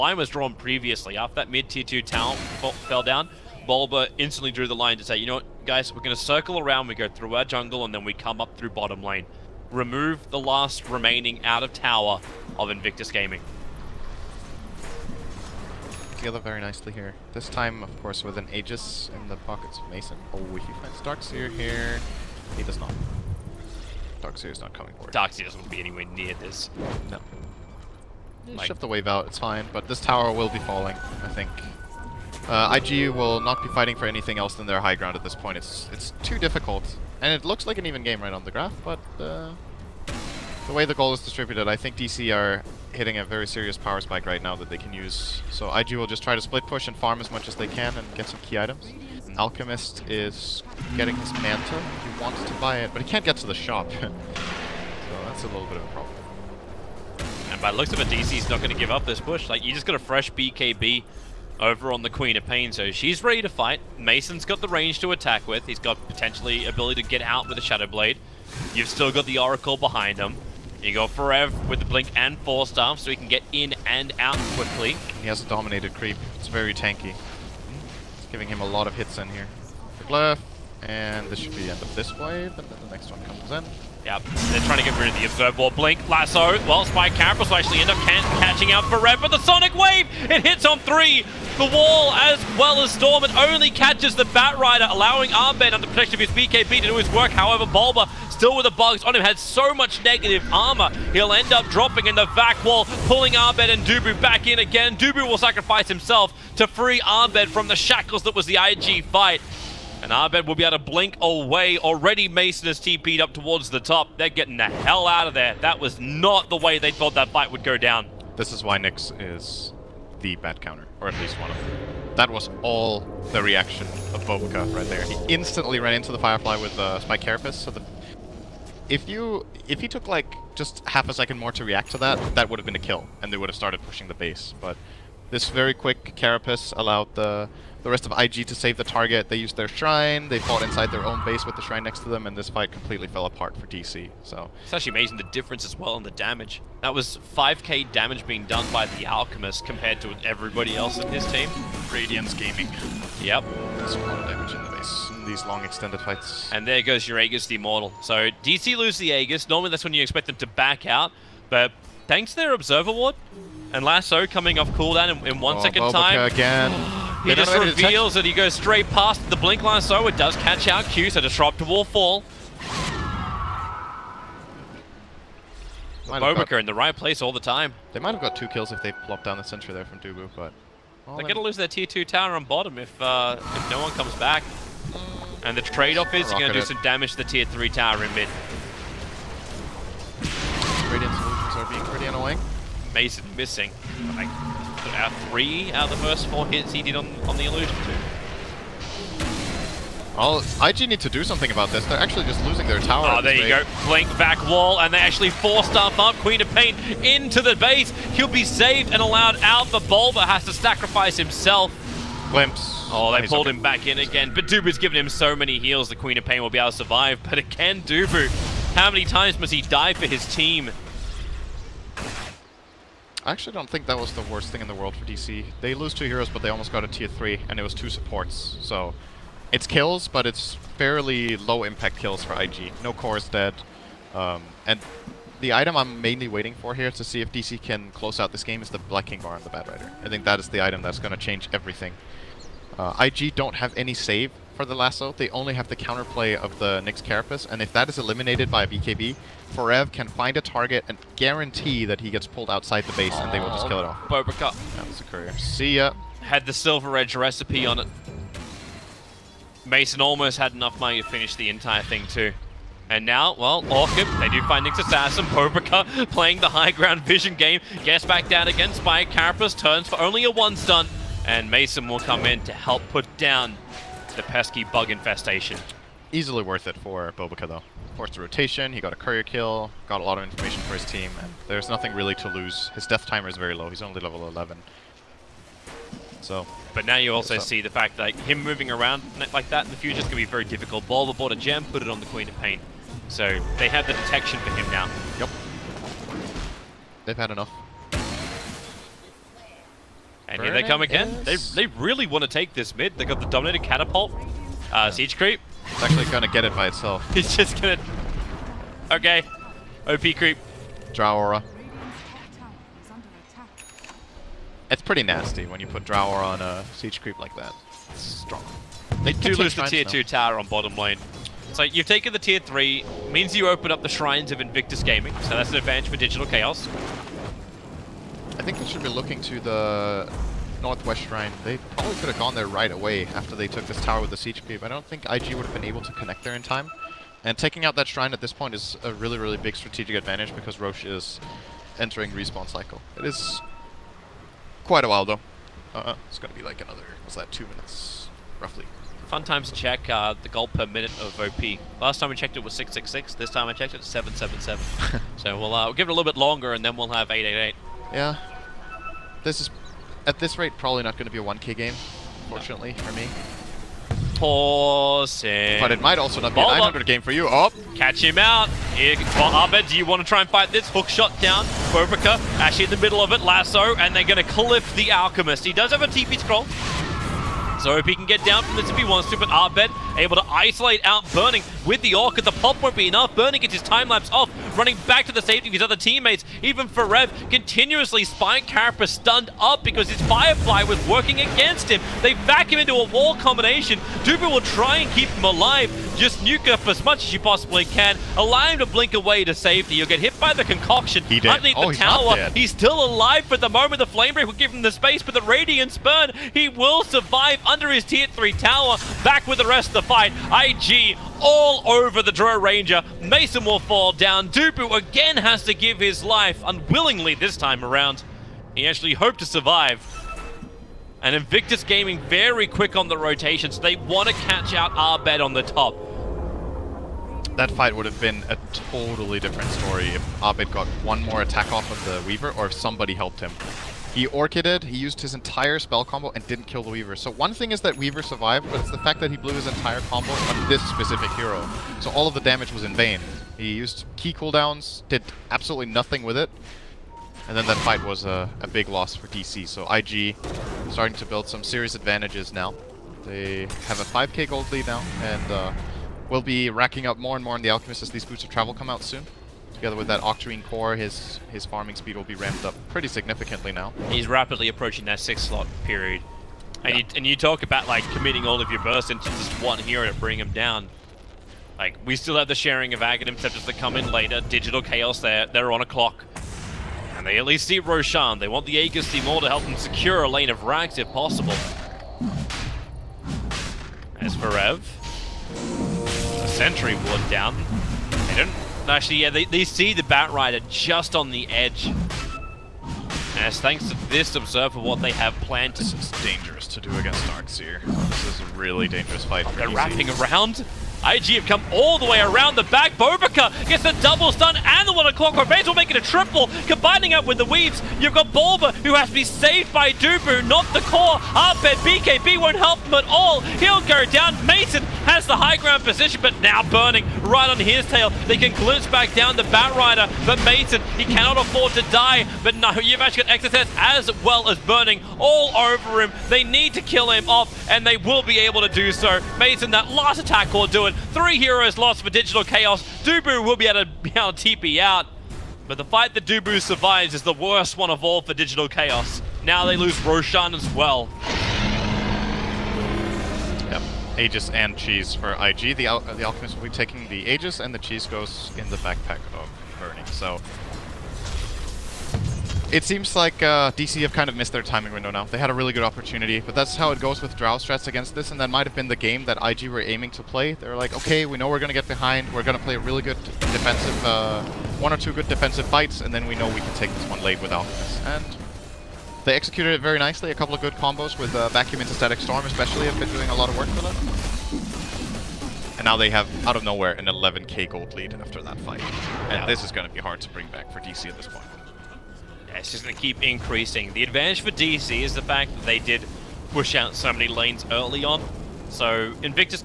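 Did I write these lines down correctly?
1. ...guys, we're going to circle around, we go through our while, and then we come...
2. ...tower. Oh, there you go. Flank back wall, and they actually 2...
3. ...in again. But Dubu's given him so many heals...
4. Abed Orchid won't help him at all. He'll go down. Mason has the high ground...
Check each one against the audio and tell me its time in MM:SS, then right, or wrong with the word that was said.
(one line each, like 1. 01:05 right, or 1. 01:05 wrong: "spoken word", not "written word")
1. 00:05 wrong: "jungle", not "while"
2. 03:22 wrong: "4", not "2"
3. 03:33 right
4. 08:31 wrong: "BKB", not "Orchid".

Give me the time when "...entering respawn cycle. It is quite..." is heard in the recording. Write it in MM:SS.
05:41.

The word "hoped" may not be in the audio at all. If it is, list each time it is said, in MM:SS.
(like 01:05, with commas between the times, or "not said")
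06:58.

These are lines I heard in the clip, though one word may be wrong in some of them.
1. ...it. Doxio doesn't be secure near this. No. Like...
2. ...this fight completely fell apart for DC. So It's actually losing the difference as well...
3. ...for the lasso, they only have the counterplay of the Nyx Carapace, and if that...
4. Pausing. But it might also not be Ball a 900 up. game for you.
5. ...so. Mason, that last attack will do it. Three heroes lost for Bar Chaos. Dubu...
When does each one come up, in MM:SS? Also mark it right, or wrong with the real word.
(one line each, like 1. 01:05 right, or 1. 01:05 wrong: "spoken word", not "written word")
1. 00:25 wrong: "anywhere", not "secure"
2. 02:22 wrong: "amazing", not "losing"
3. 04:04 right
4. 06:04 right
5. 08:48 wrong: "Digital", not "Bar".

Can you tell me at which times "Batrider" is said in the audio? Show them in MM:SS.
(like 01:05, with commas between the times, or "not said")
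01:34, 08:09, 08:39.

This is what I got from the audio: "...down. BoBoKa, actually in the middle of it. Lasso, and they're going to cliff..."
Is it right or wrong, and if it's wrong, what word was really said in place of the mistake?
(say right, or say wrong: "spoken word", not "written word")
right.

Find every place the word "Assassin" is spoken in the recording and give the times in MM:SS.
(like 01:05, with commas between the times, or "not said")
04:24.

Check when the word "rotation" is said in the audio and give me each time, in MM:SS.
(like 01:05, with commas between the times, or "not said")
04:38, 07:02.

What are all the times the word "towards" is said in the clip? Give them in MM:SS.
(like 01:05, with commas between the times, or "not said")
01:53.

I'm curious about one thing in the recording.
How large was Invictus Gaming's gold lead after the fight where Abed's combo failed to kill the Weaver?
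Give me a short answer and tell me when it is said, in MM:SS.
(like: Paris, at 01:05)
5k, at 07:33.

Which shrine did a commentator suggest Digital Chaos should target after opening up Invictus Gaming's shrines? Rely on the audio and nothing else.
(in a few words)
Northwest shrine.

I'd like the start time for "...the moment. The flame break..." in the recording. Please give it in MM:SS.
06:43.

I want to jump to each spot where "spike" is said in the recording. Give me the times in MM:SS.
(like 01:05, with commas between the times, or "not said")
00:44, 02:06, 04:28, 06:28.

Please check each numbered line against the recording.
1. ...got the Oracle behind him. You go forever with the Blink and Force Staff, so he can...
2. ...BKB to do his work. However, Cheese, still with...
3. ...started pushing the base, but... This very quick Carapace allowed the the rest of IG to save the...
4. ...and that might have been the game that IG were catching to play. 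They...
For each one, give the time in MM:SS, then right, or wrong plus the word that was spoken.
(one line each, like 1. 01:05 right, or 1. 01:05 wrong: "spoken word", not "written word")
1. 01:09 right
2. 01:36 wrong: "Bulba", not "Cheese"
3. 02:13 right
4. 09:18 wrong: "aiming", not "catching".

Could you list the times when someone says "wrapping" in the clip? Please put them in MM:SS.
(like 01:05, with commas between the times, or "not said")
08:19.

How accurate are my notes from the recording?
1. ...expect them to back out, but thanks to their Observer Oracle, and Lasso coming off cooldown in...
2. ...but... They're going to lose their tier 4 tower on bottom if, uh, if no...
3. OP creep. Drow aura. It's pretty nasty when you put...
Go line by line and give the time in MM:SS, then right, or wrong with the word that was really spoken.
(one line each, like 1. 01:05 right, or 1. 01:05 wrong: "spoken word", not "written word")
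1. 02:40 wrong: "Ward", not "Oracle"
2. 03:00 wrong: "2", not "4"
3. 05:09 right.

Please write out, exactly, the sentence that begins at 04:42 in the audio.
His death timer is very low, he's only level 11.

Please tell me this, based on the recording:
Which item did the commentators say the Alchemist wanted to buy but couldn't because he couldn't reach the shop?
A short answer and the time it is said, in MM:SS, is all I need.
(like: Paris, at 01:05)
Manta, at 00:51.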